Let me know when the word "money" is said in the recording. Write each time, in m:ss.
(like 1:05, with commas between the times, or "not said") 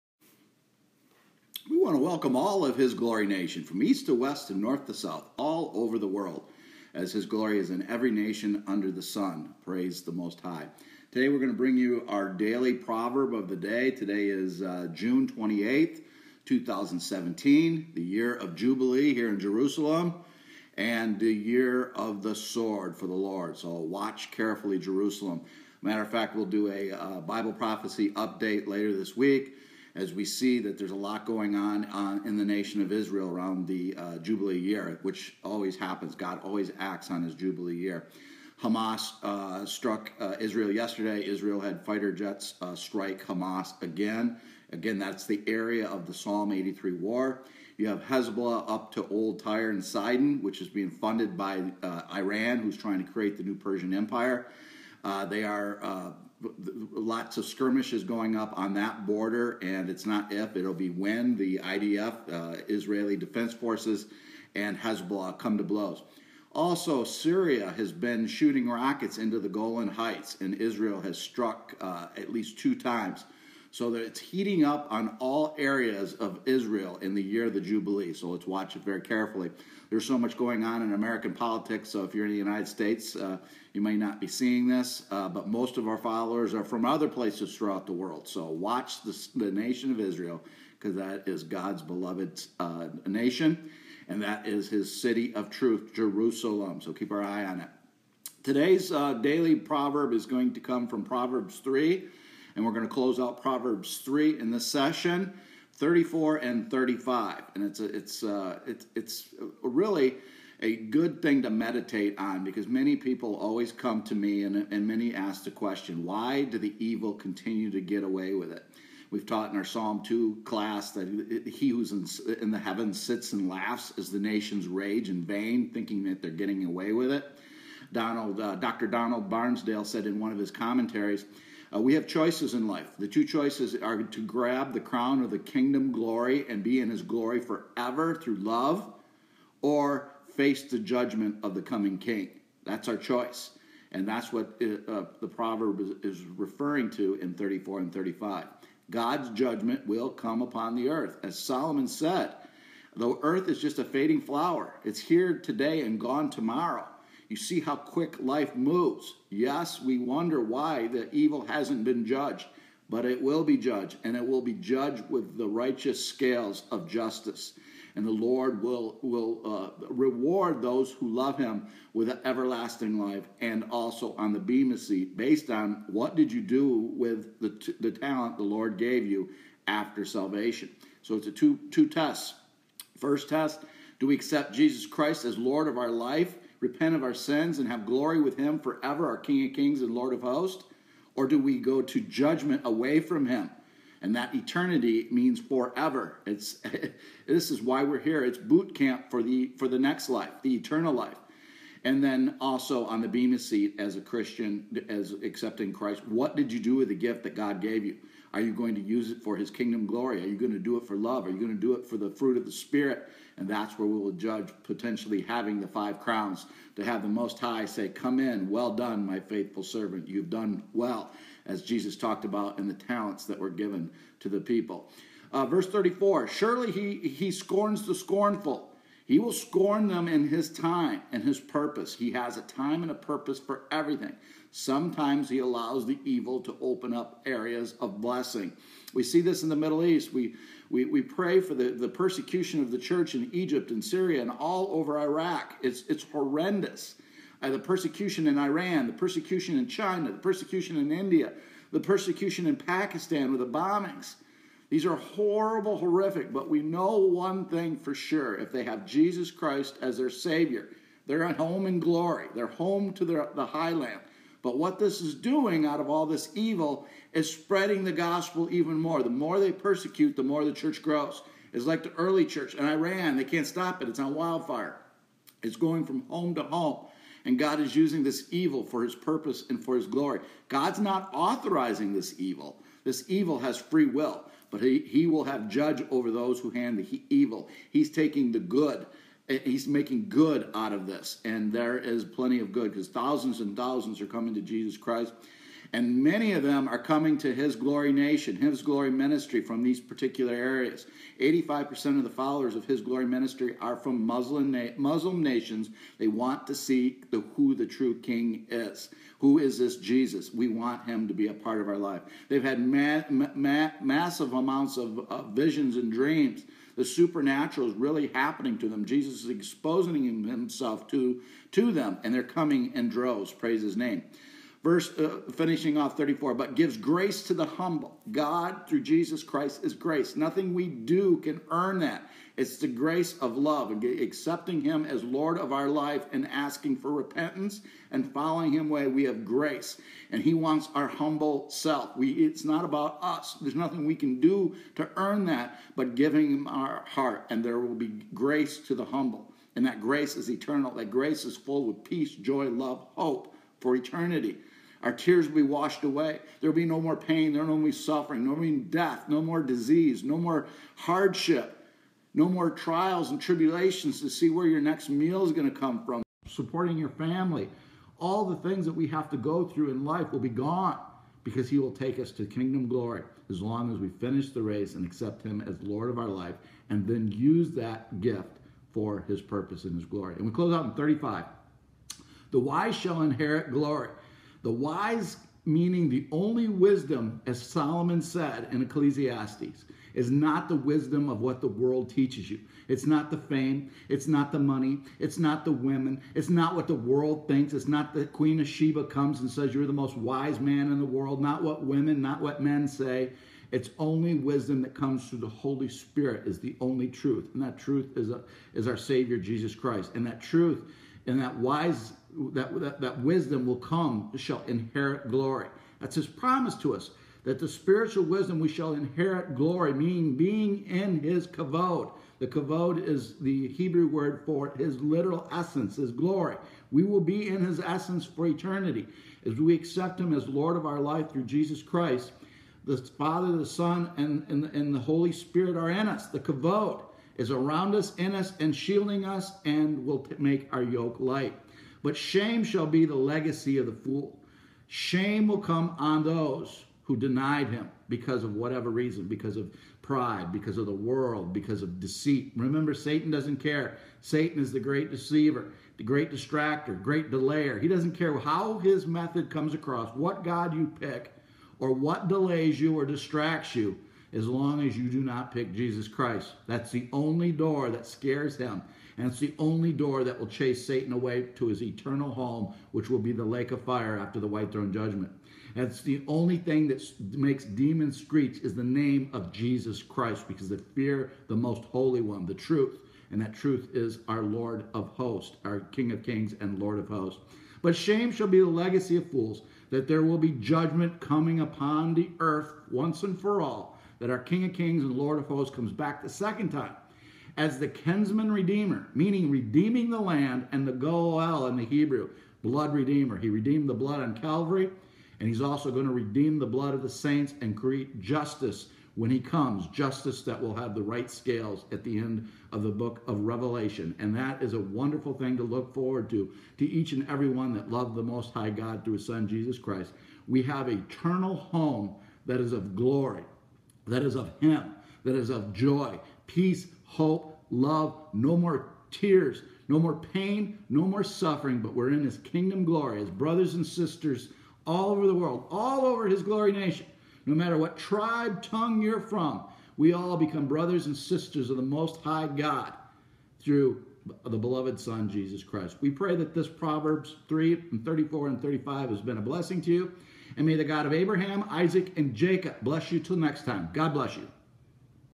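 6:34.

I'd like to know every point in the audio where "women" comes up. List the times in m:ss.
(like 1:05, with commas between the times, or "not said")
6:35, 6:41.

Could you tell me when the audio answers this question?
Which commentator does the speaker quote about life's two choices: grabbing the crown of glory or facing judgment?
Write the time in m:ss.
2:08.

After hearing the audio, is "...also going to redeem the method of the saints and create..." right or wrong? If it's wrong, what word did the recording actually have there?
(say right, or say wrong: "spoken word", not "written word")
wrong: "blood", not "method".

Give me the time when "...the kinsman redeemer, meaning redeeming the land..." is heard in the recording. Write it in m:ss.
8:17.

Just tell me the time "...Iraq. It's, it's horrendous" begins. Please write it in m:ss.
4:04.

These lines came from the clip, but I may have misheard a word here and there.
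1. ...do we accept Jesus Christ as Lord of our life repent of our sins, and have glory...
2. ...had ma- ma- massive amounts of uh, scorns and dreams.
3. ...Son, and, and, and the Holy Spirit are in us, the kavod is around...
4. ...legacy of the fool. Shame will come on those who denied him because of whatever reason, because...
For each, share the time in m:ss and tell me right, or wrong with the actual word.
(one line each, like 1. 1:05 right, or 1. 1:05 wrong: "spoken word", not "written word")
1. 3:04 right
2. 5:12 wrong: "visions", not "scorns"
3. 7:13 right
4. 7:22 right.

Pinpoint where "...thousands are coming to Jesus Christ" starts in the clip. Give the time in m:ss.
4:53.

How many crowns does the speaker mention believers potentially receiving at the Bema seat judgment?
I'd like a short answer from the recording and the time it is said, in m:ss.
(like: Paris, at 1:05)
5, at 3:35.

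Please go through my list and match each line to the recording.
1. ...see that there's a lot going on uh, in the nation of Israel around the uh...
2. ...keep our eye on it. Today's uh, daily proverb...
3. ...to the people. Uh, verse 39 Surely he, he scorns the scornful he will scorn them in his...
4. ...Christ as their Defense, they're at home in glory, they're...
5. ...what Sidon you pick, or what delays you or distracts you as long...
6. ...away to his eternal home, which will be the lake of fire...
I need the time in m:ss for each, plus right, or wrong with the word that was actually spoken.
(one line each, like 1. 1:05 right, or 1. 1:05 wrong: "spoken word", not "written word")
1. 0:30 right
2. 1:36 right
3. 3:44 wrong: "34", not "39"
4. 4:19 wrong: "Savior", not "Defense"
5. 7:39 wrong: "God", not "Sidon"
6. 7:50 right.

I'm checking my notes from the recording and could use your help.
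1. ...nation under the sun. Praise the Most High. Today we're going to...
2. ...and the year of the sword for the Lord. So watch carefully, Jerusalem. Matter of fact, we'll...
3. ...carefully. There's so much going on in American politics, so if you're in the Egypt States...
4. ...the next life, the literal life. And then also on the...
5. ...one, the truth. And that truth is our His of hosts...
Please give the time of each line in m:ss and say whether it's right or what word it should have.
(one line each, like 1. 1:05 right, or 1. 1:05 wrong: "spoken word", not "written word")
1. 0:08 right
2. 0:20 right
3. 1:18 wrong: "United", not "Egypt"
4. 3:19 wrong: "eternal", not "literal"
5. 8:02 wrong: "Lord", not "His".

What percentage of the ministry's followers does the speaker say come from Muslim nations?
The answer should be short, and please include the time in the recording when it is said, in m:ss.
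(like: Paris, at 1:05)
85%, at 5:01.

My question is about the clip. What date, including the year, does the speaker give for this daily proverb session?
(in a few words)
June 28th, 2017.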